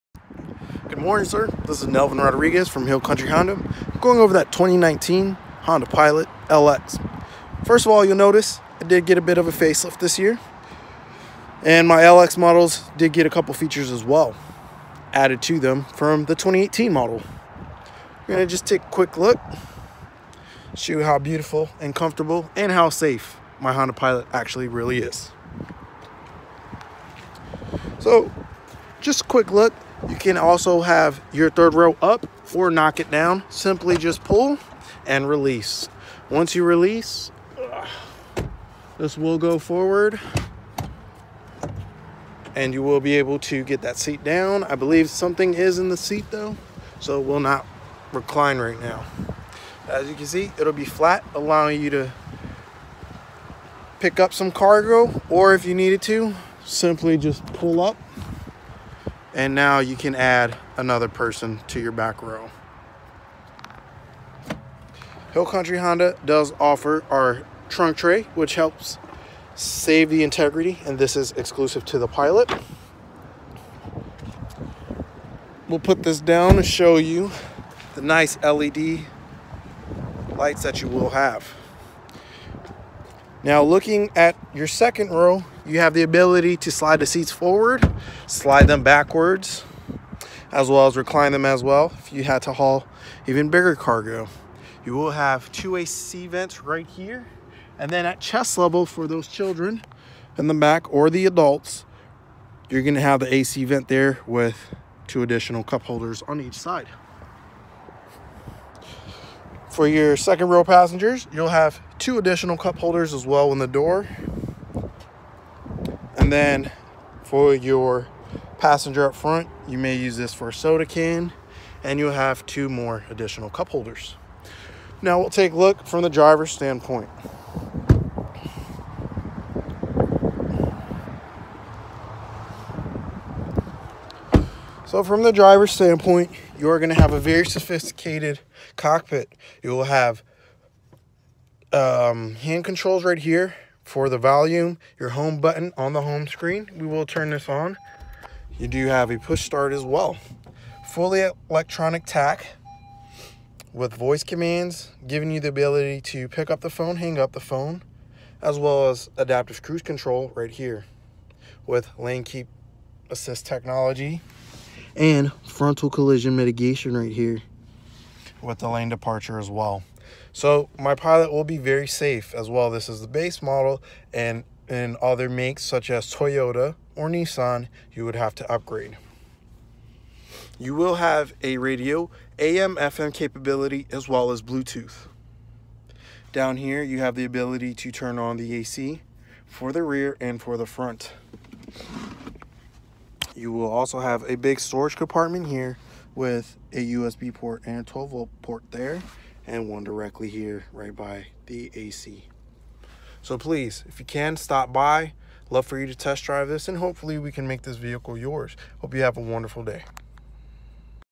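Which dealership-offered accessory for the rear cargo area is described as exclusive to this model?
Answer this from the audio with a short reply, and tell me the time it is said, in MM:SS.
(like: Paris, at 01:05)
trunk tray, at 01:07.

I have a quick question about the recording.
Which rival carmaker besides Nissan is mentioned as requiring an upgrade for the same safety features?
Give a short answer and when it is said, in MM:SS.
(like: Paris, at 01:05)
Toyota, at 02:56.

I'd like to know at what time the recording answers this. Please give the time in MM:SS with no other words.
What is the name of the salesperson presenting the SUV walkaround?
00:01.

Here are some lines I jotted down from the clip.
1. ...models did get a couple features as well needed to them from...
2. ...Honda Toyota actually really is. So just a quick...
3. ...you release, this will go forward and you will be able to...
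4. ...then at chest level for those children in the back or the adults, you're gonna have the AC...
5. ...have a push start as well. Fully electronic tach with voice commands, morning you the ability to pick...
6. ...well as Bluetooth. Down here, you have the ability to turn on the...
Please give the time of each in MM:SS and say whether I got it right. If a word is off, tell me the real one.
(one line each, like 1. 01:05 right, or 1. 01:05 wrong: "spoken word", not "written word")
1. 00:12 wrong: "added", not "needed"
2. 00:23 wrong: "Pilot", not "Toyota"
3. 00:36 right
4. 01:37 right
5. 02:28 wrong: "giving", not "morning"
6. 03:04 right.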